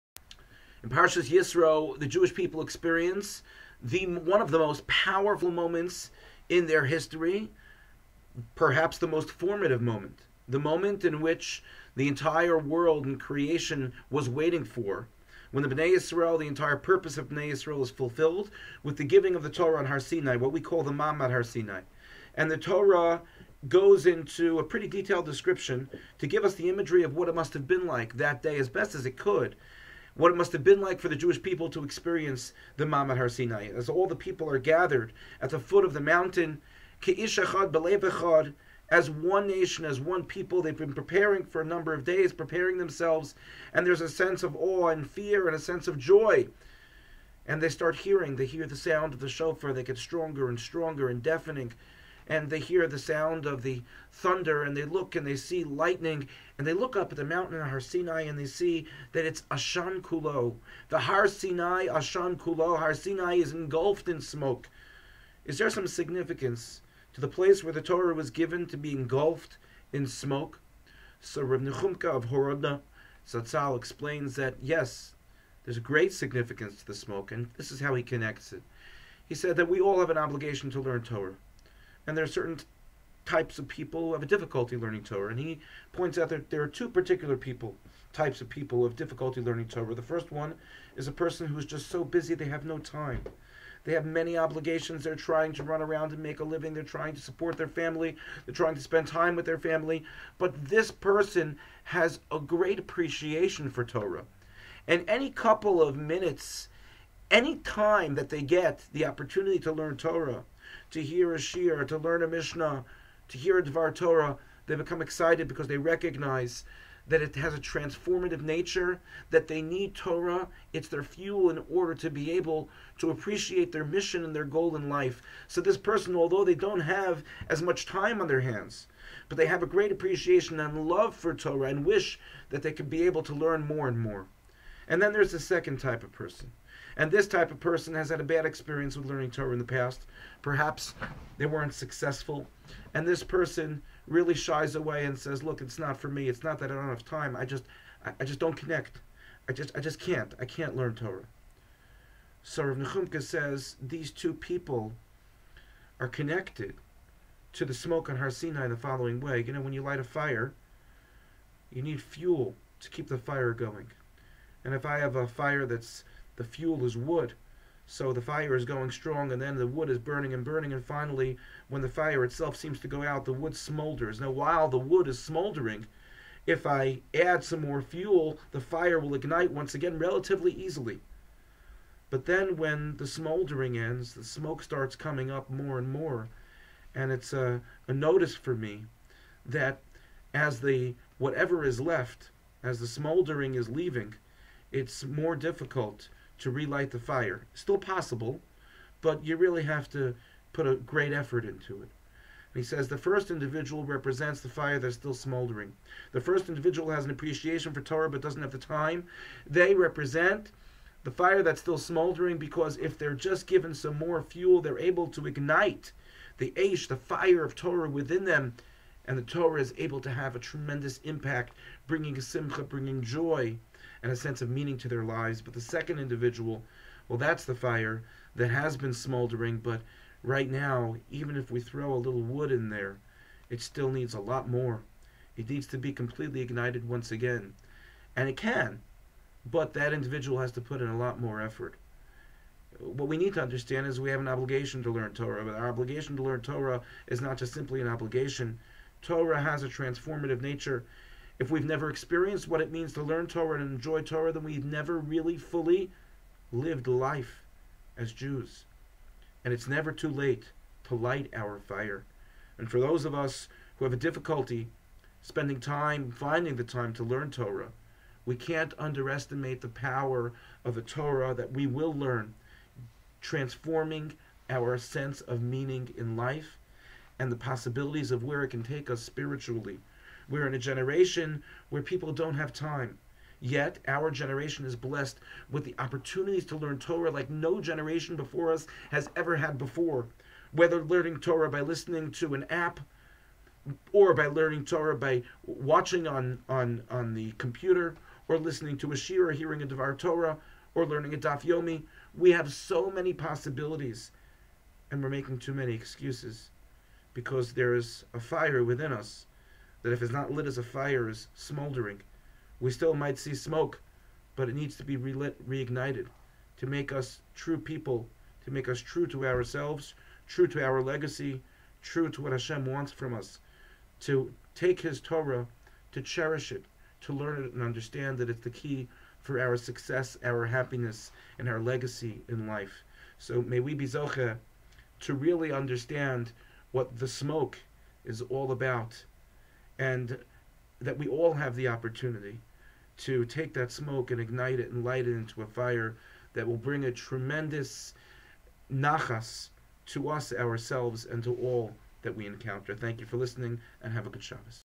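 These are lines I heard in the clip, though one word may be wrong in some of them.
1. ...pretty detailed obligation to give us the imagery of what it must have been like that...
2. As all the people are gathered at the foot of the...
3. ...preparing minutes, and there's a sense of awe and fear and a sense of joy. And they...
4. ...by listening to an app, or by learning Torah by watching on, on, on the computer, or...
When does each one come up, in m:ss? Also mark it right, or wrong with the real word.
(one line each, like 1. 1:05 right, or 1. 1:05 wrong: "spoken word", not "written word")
1. 0:24 wrong: "description", not "obligation"
2. 0:33 right
3. 0:42 wrong: "themselves", not "minutes"
4. 4:51 right.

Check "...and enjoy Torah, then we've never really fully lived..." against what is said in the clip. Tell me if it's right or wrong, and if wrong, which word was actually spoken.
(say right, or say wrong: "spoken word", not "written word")
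right.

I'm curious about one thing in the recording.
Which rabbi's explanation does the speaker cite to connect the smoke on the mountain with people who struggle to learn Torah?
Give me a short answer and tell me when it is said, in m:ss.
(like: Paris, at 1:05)
Rav Nechumka of Horodna, at 1:11.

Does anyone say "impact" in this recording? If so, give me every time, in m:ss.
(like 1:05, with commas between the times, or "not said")
3:40.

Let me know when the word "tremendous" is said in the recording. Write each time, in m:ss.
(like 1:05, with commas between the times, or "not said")
3:40, 5:46.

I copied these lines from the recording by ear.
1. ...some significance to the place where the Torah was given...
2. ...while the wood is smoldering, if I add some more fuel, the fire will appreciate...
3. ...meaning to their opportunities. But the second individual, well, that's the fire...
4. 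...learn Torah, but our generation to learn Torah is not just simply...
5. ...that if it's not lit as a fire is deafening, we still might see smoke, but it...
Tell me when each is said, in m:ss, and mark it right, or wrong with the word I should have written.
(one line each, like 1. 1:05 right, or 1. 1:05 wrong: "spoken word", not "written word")
1. 1:05 right
2. 2:54 wrong: "ignite", not "appreciate"
3. 3:44 wrong: "lives", not "opportunities"
4. 4:04 wrong: "obligation", not "generation"
5. 5:09 wrong: "smoldering", not "deafening".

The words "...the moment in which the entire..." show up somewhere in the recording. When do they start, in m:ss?
0:10.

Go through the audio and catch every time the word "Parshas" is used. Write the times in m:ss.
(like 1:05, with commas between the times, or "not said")
0:00.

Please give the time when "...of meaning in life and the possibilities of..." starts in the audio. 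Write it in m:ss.
4:35.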